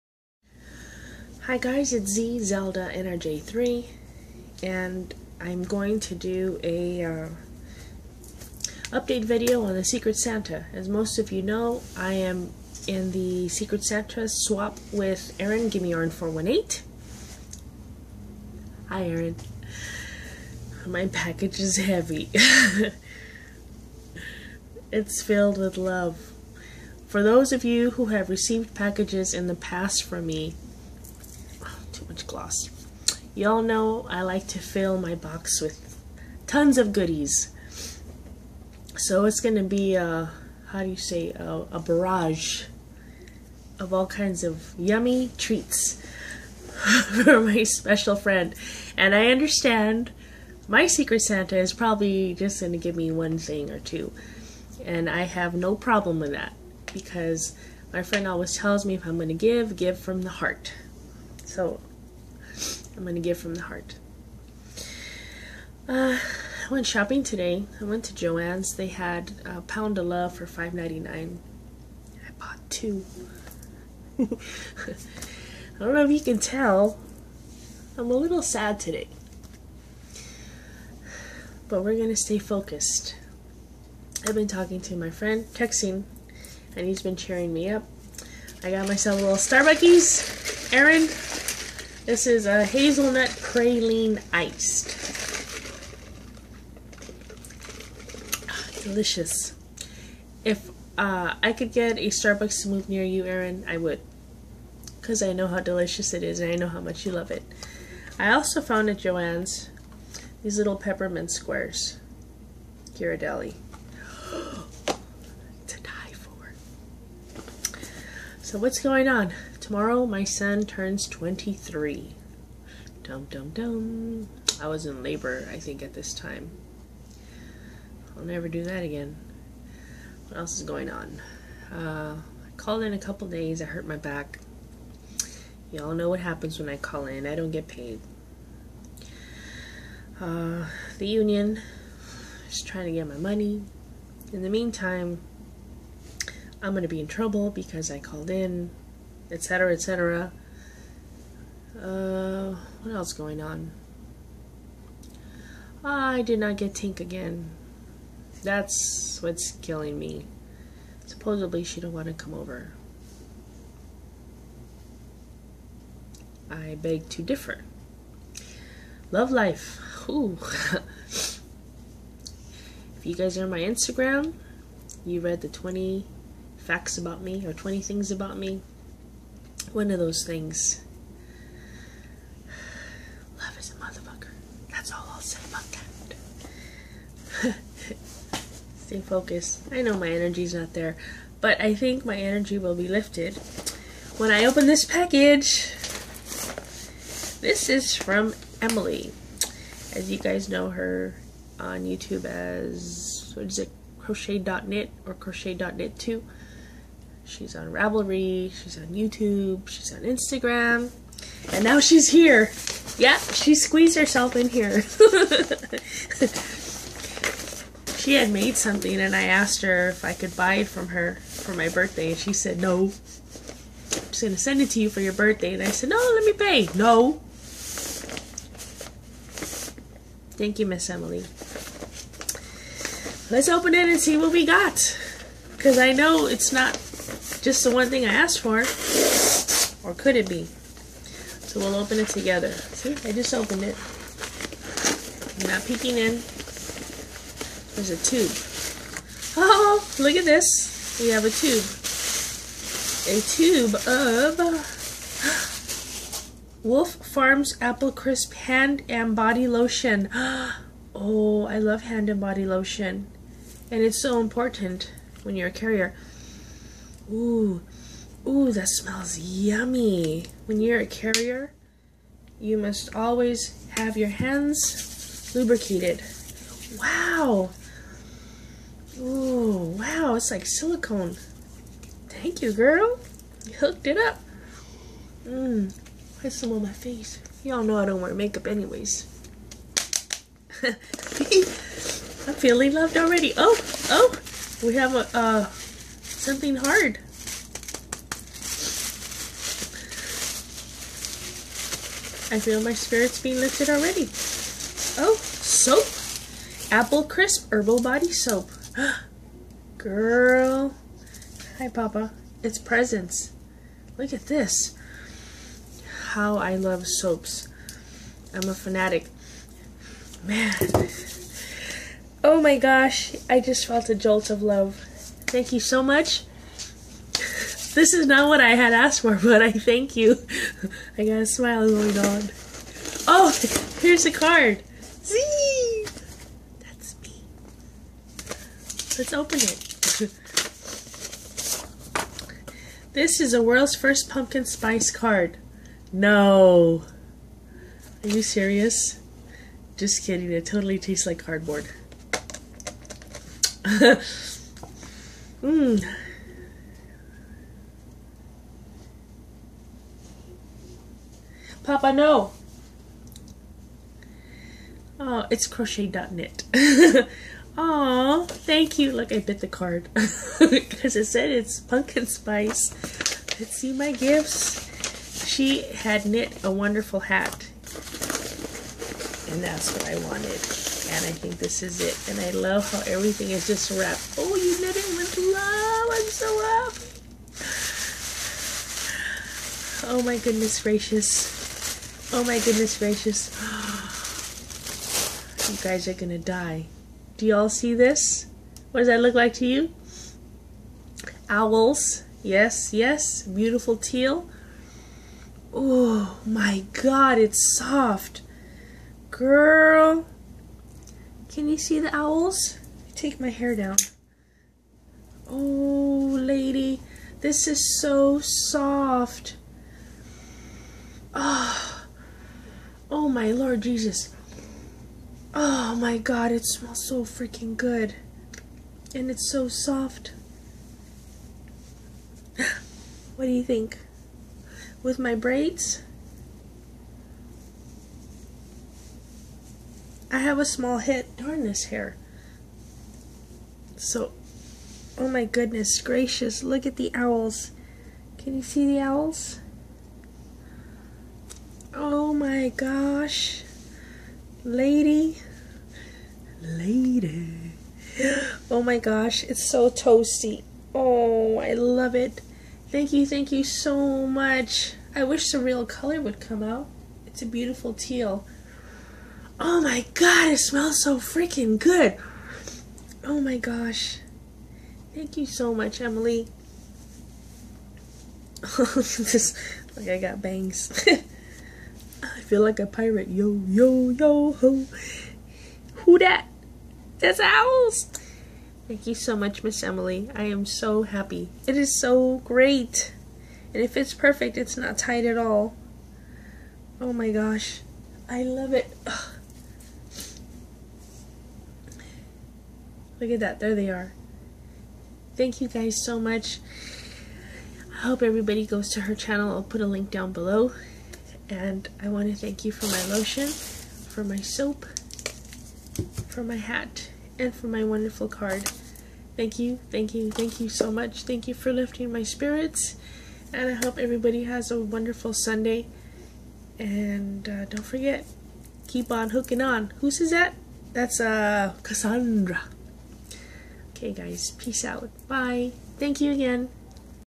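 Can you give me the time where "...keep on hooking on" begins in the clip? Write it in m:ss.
8:48.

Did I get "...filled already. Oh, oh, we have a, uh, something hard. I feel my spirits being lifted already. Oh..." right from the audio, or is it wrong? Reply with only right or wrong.
wrong.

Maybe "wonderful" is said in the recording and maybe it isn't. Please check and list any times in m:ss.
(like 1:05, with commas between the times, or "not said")
6:16, 8:37, 8:44.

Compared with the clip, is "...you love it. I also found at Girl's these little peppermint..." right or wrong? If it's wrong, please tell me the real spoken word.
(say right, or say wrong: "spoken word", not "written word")
wrong: "Joann", not "Girl".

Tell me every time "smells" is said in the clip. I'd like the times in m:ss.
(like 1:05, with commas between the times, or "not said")
4:28, 7:06, 7:50.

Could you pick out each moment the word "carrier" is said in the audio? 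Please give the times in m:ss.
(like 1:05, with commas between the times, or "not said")
4:25, 4:30.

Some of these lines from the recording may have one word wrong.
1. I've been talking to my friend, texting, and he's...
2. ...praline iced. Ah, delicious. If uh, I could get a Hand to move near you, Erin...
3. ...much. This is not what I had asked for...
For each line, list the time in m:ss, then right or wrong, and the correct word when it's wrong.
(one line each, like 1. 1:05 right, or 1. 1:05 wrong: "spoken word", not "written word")
1. 1:24 right
2. 1:33 wrong: "Starbucks", not "Hand"
3. 5:25 right.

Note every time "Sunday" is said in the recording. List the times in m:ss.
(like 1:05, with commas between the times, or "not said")
8:45.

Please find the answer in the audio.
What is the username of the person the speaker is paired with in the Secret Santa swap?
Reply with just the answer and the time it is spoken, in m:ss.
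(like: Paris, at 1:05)
Gimme Aaron 418, at 0:15.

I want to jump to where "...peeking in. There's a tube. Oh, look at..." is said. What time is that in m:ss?
4:05.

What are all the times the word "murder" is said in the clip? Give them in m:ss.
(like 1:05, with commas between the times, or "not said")
not said.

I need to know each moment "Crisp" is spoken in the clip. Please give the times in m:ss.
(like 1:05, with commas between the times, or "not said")
4:17, 5:07.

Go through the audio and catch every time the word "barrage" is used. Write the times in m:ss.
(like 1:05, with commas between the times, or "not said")
0:41.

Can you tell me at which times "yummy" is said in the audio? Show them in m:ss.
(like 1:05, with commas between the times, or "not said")
0:44, 4:29.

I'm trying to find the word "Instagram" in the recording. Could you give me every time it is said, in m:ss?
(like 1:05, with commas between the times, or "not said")
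2:53, 3:30.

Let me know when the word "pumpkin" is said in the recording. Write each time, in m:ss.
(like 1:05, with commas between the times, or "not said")
5:44, 6:11.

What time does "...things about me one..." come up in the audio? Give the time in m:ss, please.
2:57.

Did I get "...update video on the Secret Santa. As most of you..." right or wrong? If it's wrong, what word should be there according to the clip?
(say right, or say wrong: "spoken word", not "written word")
right.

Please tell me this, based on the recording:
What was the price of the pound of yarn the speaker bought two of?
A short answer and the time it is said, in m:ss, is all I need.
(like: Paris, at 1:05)
$5.99, at 1:10.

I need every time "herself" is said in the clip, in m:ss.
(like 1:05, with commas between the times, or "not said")
3:33.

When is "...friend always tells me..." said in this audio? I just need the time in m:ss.
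0:58.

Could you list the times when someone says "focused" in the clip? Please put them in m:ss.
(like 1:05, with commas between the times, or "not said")
1:22, 3:09.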